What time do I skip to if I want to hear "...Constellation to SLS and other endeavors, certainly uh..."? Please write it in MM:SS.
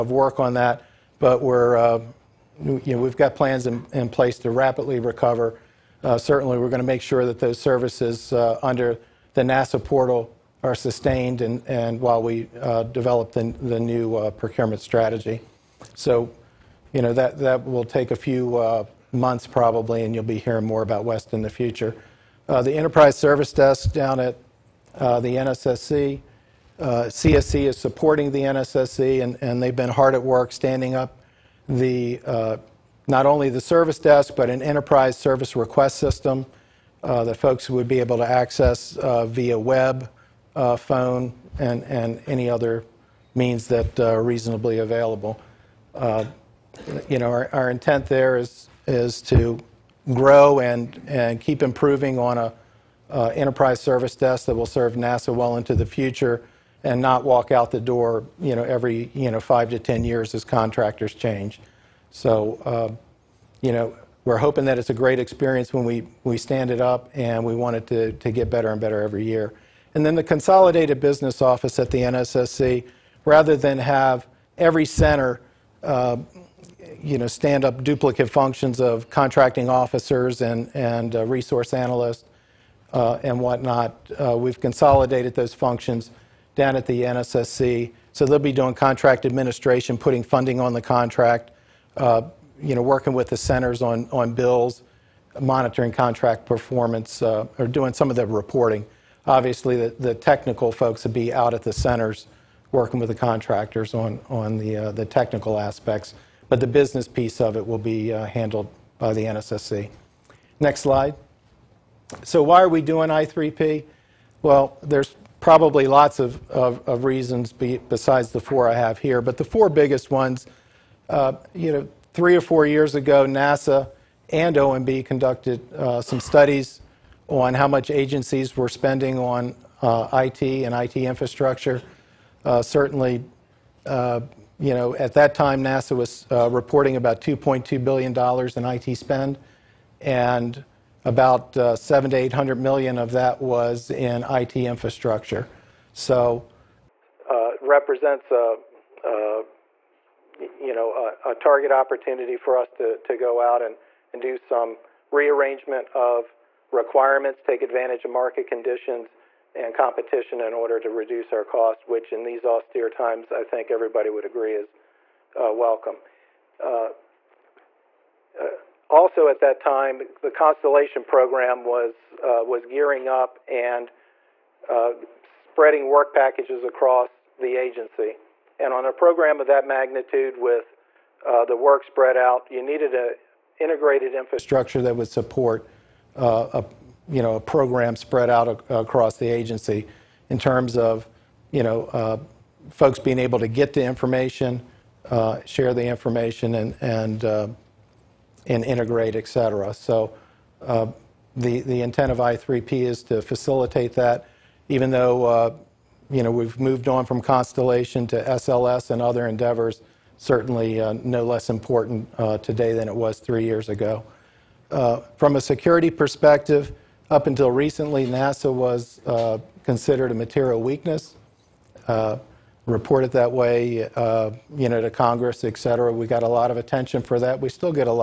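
03:27.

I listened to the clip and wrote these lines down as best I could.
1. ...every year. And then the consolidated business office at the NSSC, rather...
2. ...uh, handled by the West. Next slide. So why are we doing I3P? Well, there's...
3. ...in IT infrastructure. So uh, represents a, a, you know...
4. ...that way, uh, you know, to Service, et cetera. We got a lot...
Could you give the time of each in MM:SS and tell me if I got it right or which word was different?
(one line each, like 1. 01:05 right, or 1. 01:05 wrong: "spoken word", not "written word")
1. 01:09 right
2. 01:48 wrong: "NSSC", not "West"
3. 02:23 right
4. 03:43 wrong: "Congress", not "Service".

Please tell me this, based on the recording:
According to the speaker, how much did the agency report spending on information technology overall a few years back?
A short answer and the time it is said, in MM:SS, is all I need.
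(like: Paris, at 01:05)
$2.2 billion, at 02:17.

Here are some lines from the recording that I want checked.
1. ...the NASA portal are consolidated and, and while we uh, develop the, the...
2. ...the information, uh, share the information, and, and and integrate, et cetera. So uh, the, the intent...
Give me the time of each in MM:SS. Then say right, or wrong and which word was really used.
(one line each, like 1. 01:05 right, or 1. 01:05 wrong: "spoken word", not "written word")
1. 00:09 wrong: "sustained", not "consolidated"
2. 03:13 right.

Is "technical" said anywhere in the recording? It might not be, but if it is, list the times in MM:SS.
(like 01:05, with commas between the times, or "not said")
01:40, 01:45.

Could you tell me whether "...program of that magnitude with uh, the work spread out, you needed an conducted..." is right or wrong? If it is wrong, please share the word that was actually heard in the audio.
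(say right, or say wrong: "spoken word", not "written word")
wrong: "integrated", not "conducted".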